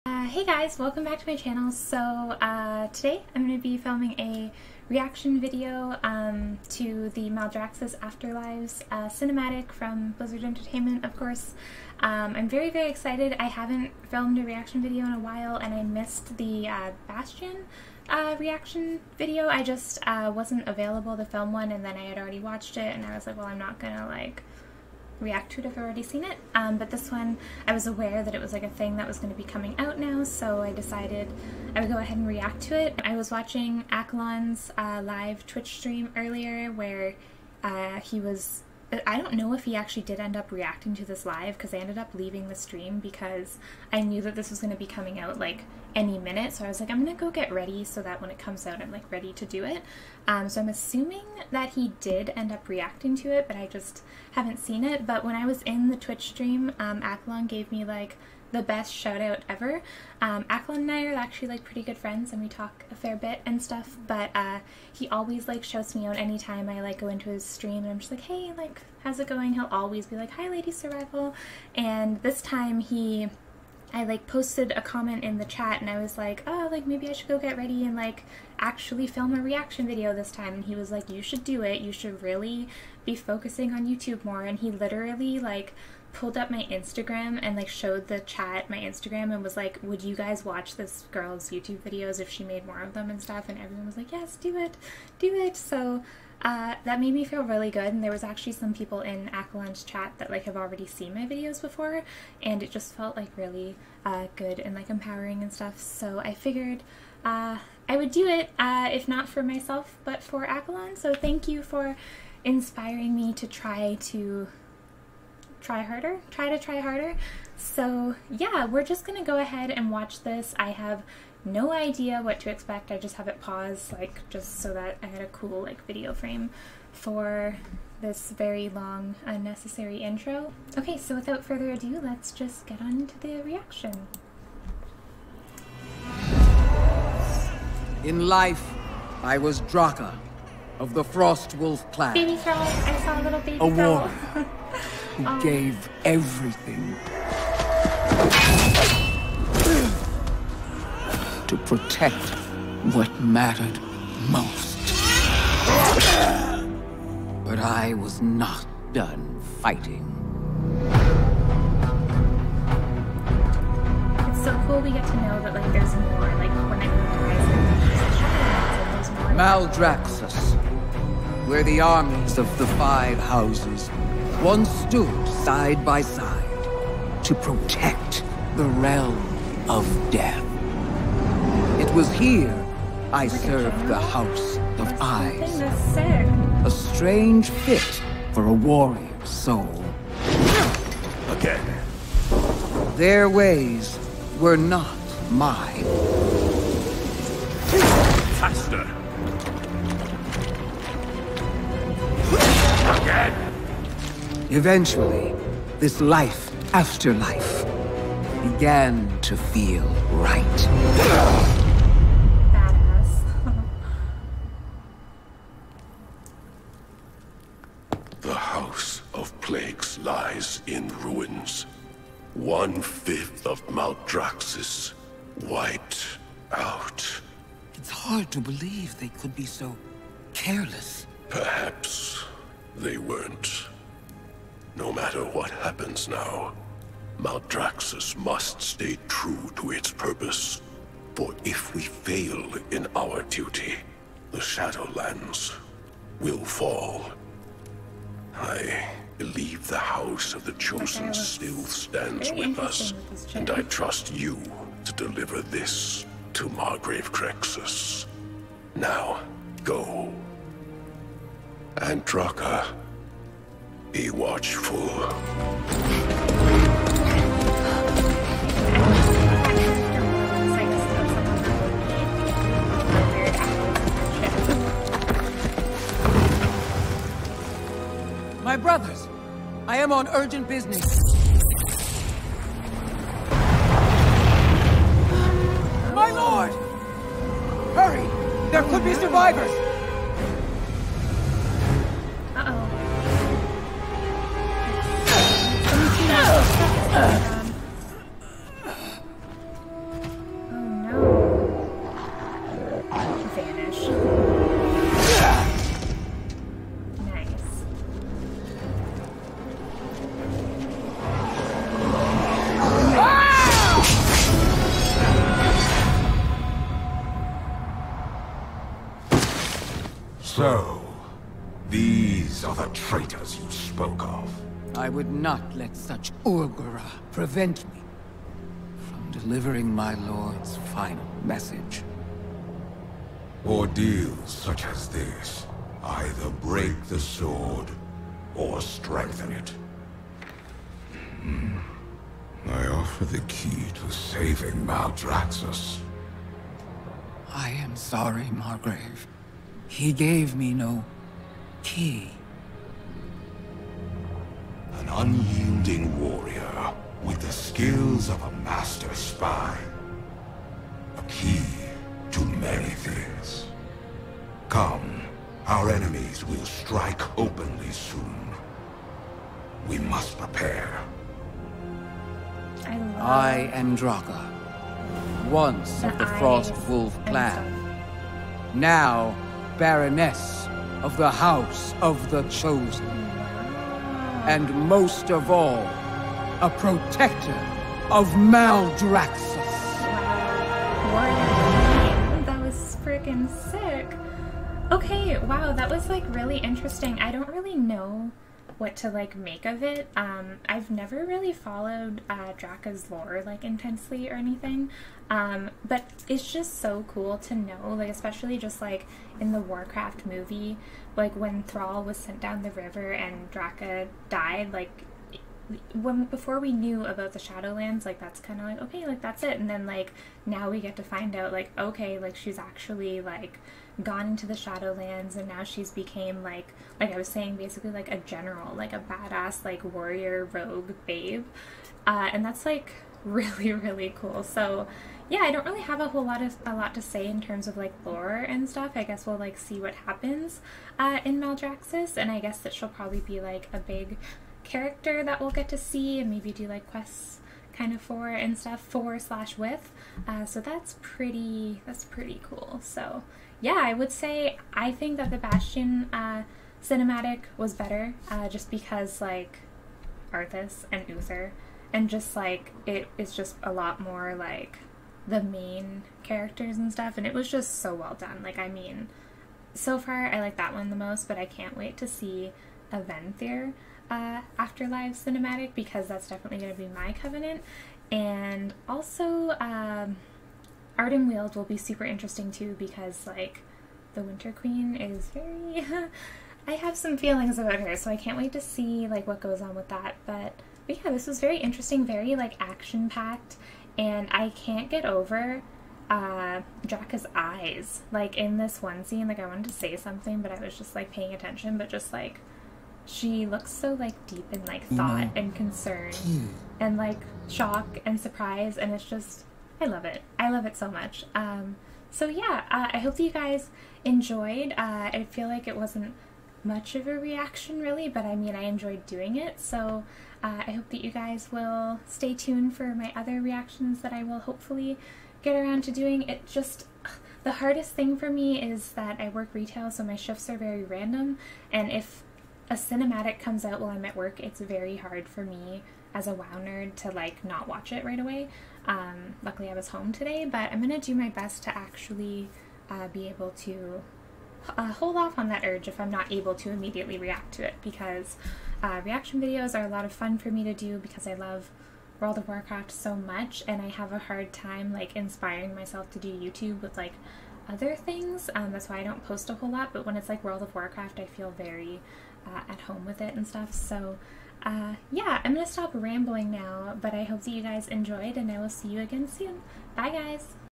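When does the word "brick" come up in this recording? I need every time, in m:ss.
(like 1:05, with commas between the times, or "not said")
not said.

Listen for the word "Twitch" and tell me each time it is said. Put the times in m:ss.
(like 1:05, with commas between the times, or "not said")
0:35, 0:55.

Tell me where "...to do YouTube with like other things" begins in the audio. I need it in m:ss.
9:15.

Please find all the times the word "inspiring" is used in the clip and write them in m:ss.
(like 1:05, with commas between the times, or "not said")
1:52, 9:14.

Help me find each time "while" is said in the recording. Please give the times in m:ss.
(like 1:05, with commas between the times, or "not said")
0:15, 8:53.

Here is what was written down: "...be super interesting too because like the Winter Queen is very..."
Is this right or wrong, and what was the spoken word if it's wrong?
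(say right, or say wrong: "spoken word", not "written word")
right.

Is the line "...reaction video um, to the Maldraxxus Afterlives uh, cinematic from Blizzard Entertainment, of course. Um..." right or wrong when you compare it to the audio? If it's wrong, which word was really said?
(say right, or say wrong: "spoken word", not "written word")
right.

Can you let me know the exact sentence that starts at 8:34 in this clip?
Uh, I feel like it wasn't much of a reaction really, but I mean I enjoyed doing it.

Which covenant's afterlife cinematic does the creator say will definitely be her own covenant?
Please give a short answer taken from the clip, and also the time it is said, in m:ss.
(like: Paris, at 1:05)
Aventhyr, at 7:52.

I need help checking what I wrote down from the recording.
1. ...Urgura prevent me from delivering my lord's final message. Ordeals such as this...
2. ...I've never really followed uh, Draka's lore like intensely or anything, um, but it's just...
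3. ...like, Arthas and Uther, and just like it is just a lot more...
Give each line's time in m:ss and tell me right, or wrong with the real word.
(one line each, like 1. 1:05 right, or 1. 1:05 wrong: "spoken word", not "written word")
1. 5:26 right
2. 6:40 right
3. 7:39 right.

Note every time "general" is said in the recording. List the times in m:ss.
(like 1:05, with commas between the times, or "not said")
7:07.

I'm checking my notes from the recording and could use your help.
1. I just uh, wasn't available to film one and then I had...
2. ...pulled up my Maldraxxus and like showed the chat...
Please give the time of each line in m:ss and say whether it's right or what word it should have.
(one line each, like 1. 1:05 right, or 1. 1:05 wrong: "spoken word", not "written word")
1. 0:19 right
2. 1:26 wrong: "Instagram", not "Maldraxxus".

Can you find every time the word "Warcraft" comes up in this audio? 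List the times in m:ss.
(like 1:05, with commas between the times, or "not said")
6:49, 9:12, 9:20.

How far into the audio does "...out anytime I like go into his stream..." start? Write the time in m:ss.
1:06.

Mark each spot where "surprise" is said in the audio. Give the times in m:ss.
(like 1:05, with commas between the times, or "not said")
8:27.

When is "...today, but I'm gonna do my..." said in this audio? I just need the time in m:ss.
8:59.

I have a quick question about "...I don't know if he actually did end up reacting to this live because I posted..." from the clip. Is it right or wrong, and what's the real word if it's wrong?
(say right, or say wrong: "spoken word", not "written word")
wrong: "ended", not "posted".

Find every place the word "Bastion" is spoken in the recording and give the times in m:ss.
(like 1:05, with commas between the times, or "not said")
0:17, 7:35.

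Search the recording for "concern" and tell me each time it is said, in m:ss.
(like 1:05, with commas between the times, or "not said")
8:25.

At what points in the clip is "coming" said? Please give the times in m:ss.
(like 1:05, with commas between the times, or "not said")
0:29, 0:44.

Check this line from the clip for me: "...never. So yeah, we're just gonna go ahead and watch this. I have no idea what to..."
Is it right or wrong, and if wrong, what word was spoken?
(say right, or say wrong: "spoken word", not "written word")
wrong: "harder", not "never".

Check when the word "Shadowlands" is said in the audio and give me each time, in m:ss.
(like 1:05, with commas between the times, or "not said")
4:04, 6:57, 7:04.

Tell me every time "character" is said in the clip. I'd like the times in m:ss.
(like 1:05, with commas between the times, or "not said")
7:24, 7:46.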